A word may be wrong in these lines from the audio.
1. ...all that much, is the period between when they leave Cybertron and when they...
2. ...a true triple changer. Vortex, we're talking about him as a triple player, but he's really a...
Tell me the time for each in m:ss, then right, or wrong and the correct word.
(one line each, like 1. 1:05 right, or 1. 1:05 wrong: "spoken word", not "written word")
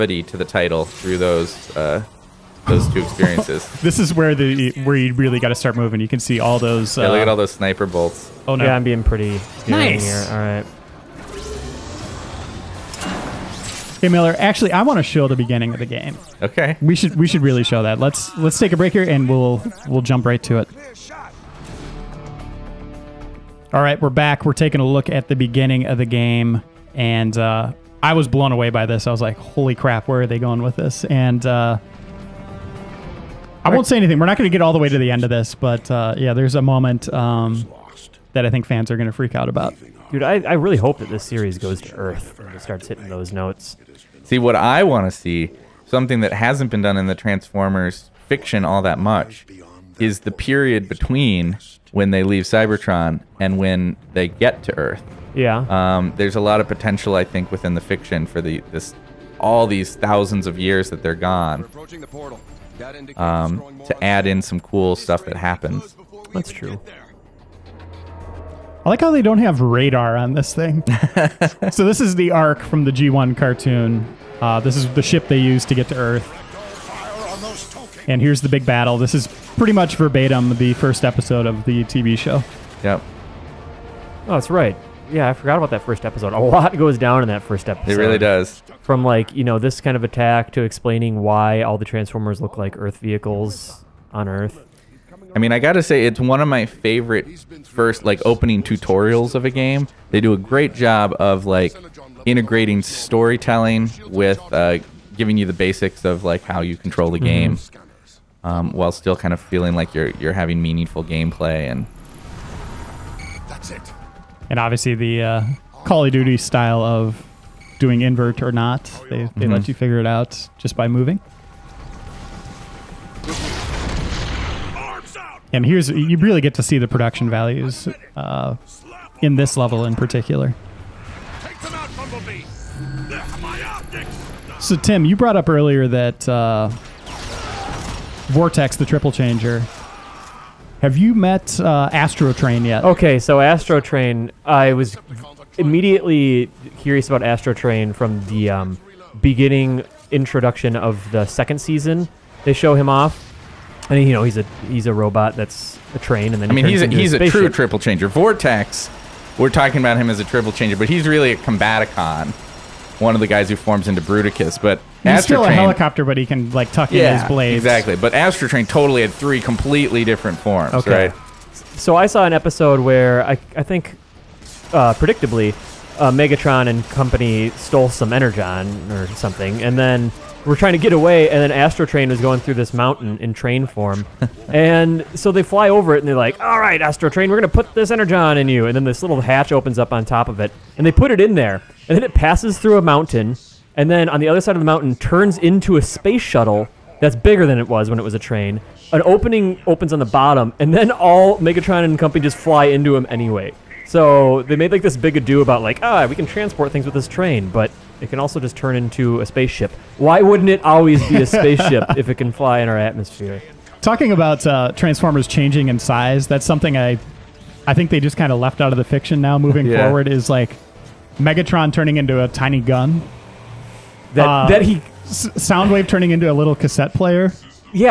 1. 0:48 right
2. 2:37 wrong: "changer", not "player".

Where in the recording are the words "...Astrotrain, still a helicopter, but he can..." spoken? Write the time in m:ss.
2:45.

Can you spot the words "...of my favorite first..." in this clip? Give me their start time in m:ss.
1:36.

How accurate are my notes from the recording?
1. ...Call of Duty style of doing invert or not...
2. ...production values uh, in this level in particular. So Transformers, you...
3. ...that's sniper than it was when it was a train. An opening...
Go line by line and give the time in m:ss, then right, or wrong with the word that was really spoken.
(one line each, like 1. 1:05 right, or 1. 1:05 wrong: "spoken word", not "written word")
1. 1:55 right
2. 2:06 wrong: "Tim", not "Transformers"
3. 3:16 wrong: "bigger", not "sniper".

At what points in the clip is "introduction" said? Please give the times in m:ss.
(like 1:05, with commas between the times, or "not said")
2:30.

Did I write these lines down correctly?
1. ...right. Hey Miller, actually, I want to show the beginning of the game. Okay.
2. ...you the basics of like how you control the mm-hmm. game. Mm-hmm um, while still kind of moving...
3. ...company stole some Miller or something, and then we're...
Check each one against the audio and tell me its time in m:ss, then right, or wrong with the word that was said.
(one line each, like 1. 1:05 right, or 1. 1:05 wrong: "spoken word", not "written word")
1. 0:10 right
2. 1:45 wrong: "feeling", not "moving"
3. 2:56 wrong: "Energon", not "Miller".